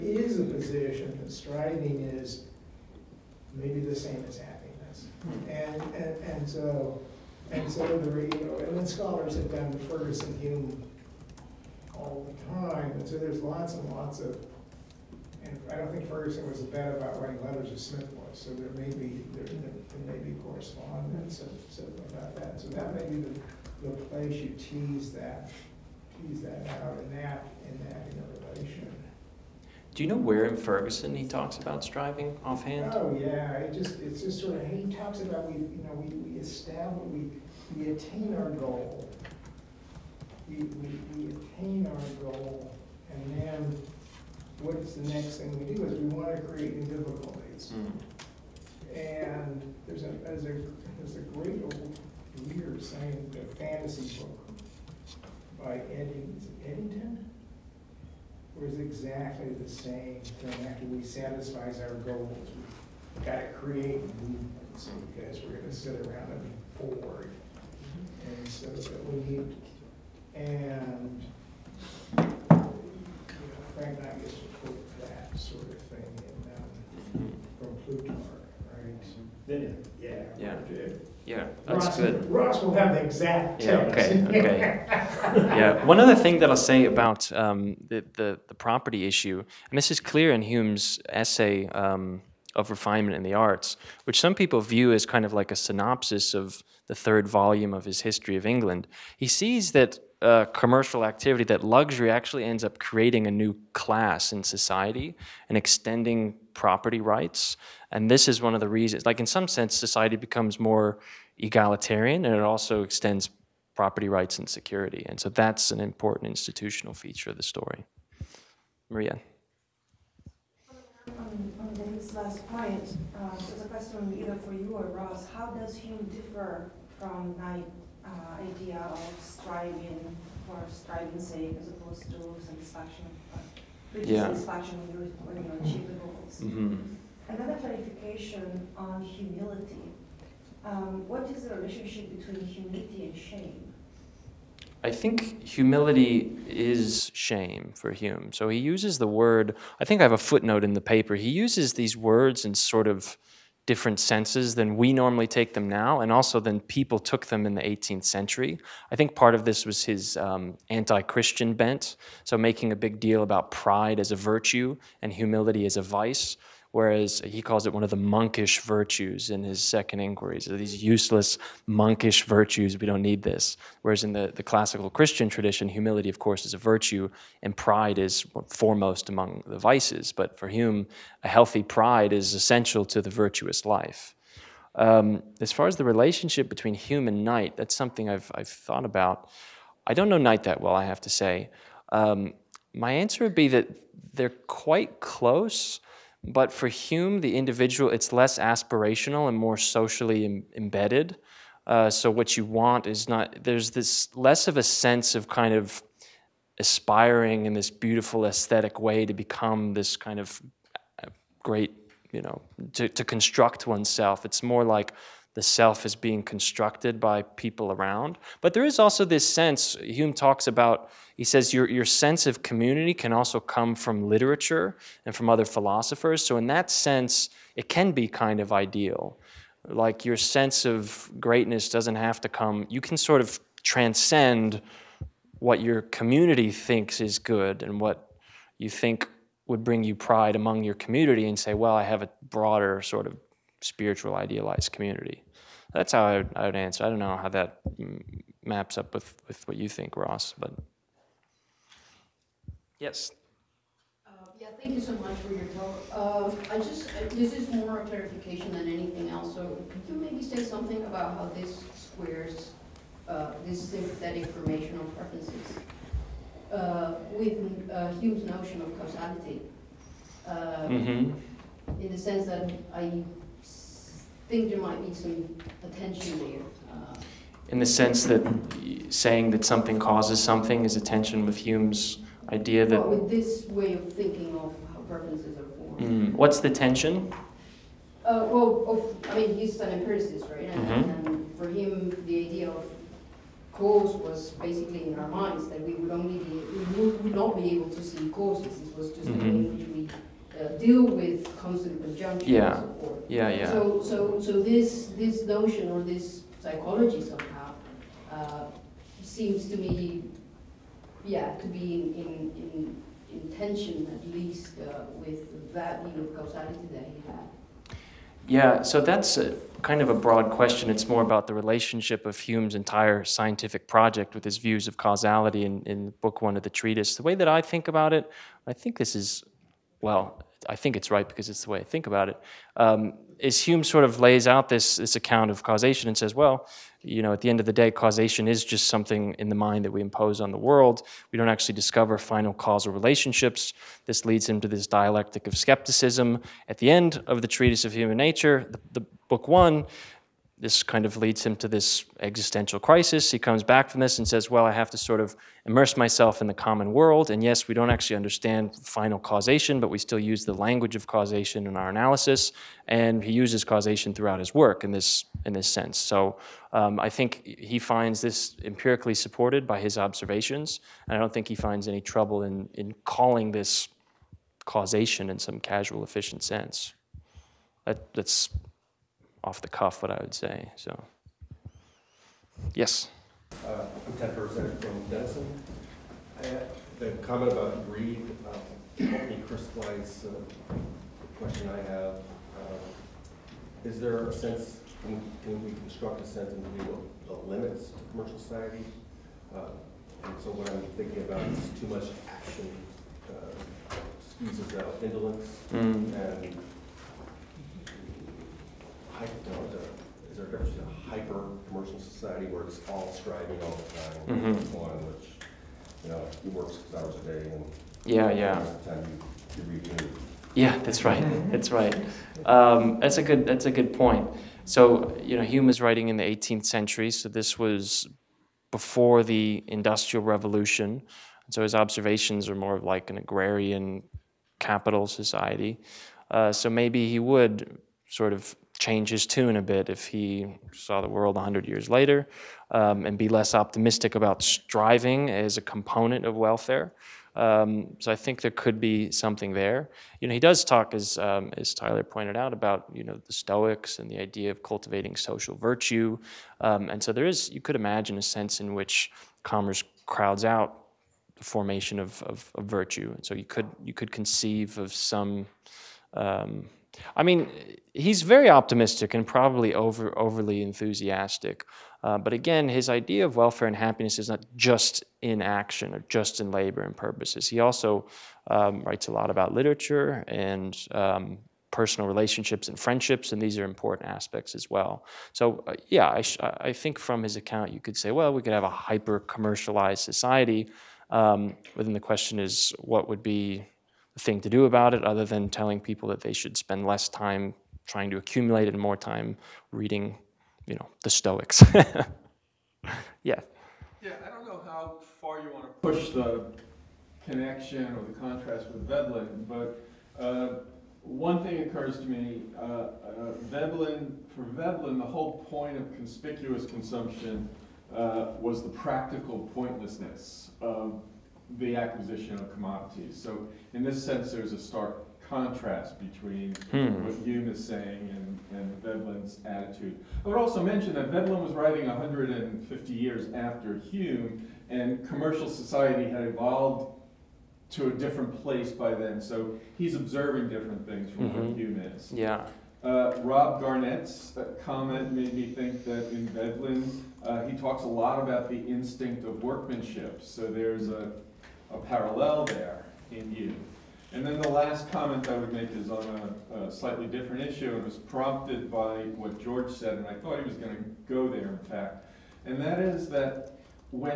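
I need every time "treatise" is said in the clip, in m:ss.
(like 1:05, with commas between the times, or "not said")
5:26, 5:47.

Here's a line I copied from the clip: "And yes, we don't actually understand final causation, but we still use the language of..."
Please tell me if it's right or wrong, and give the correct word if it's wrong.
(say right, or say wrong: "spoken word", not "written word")
right.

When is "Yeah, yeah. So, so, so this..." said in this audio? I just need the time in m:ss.
5:03.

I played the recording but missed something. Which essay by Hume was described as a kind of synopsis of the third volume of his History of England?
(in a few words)
Of Refinement in the Arts.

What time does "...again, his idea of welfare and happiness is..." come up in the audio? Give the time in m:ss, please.
7:52.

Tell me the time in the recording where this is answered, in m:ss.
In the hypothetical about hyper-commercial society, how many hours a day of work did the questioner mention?
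6:56.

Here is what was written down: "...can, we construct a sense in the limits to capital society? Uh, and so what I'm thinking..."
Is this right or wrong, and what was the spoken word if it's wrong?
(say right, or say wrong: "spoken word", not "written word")
wrong: "commercial", not "capital".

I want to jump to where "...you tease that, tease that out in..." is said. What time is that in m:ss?
0:24.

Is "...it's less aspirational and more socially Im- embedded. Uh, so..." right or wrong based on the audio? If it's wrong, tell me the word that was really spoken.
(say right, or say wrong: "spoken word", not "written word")
right.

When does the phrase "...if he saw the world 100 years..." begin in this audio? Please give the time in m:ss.
7:19.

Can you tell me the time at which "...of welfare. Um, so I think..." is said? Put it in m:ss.
7:26.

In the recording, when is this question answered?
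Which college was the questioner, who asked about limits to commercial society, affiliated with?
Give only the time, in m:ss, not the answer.
6:24.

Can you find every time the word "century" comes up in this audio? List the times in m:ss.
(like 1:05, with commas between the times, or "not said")
2:38, 7:06.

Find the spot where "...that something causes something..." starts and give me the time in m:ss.
4:39.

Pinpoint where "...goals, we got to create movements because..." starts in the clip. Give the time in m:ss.
1:01.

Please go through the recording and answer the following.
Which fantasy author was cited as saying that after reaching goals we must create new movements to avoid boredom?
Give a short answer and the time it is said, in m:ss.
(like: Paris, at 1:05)
Eddington, at 0:55.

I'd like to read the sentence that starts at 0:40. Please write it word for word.
We, we, we attain our goal and then what's the next thing we do is we want to create new difficulties.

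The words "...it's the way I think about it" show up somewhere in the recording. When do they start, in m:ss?
5:31.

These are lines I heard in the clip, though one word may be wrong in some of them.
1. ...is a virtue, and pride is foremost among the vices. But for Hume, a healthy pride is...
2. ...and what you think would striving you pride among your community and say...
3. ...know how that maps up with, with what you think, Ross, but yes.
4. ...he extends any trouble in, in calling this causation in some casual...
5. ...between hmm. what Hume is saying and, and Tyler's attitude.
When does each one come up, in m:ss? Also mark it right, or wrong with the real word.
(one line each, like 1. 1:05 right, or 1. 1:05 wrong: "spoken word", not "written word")
1. 2:56 right
2. 3:57 wrong: "bring", not "striving"
3. 4:07 right
4. 6:11 wrong: "finds", not "extends"
5. 8:45 wrong: "Veblen", not "Tyler".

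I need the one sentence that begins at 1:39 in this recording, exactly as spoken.
He sees that uh, commercial activity, that luxury actually ends up creating a new class in society and extending property rights.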